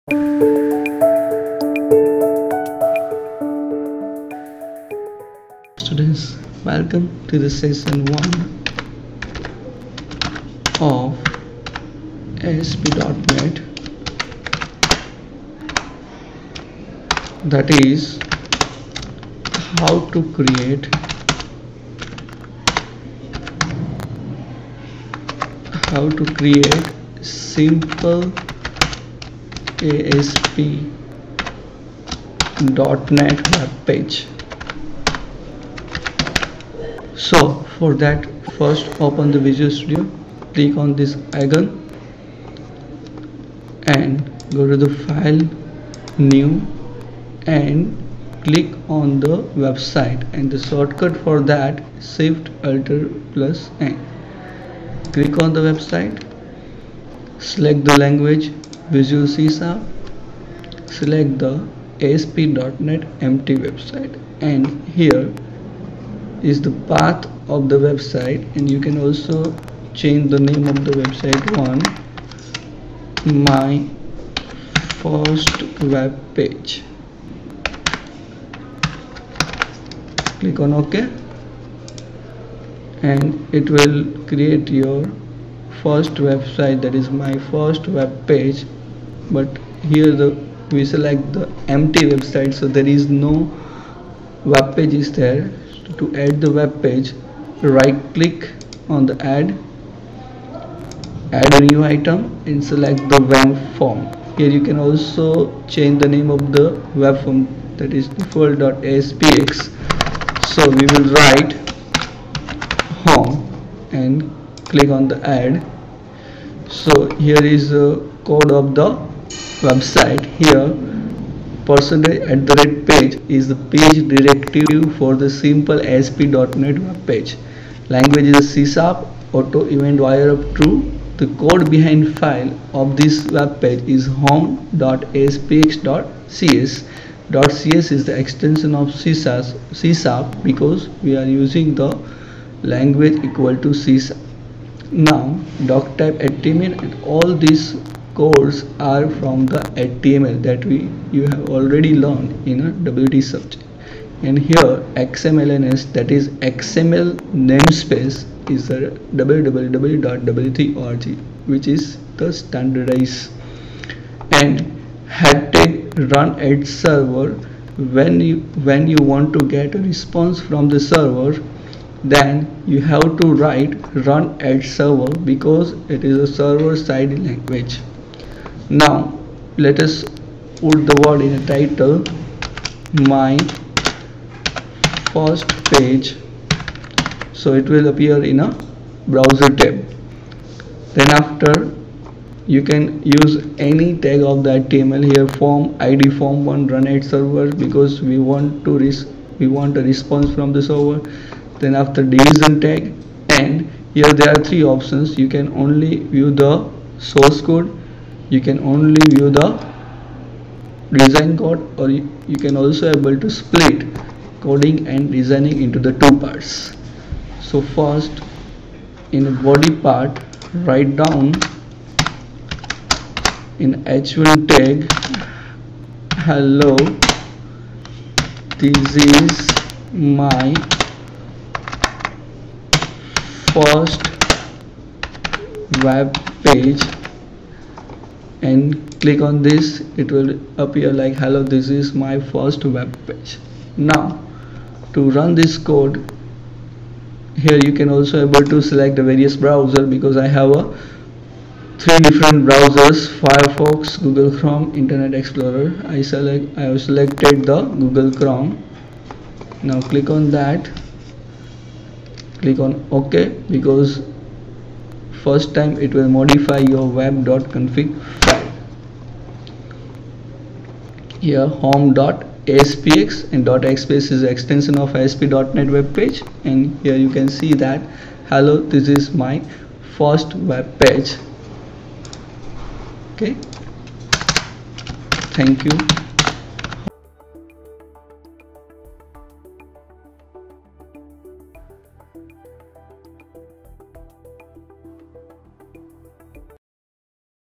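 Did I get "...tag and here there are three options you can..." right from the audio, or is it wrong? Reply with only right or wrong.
right.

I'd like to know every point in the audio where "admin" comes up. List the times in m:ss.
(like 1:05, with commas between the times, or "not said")
2:26.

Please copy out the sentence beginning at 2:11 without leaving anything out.
The code behind file of this web page is home.aspx.cs.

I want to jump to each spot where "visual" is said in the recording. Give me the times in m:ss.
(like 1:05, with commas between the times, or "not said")
0:39, 0:58.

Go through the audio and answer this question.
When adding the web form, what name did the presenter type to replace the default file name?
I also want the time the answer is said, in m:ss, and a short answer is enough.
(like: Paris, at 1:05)
home, at 1:53.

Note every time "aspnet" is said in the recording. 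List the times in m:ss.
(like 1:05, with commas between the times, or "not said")
0:12, 0:29, 1:02, 2:05, 4:34.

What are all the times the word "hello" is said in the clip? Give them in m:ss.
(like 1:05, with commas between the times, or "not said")
3:46, 4:01, 4:38.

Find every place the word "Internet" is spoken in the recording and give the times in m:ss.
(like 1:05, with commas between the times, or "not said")
4:14.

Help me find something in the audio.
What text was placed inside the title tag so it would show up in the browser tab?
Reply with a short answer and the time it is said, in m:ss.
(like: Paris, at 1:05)
my first page, at 3:03.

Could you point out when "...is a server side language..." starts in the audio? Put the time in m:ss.
2:56.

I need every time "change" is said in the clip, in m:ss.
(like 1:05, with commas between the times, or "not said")
1:09, 1:45.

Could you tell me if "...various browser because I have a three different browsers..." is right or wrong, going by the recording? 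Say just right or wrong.
right.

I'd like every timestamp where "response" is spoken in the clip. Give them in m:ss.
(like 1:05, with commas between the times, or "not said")
2:49, 3:19.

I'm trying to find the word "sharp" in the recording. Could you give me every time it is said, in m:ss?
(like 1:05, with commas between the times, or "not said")
0:59, 2:19.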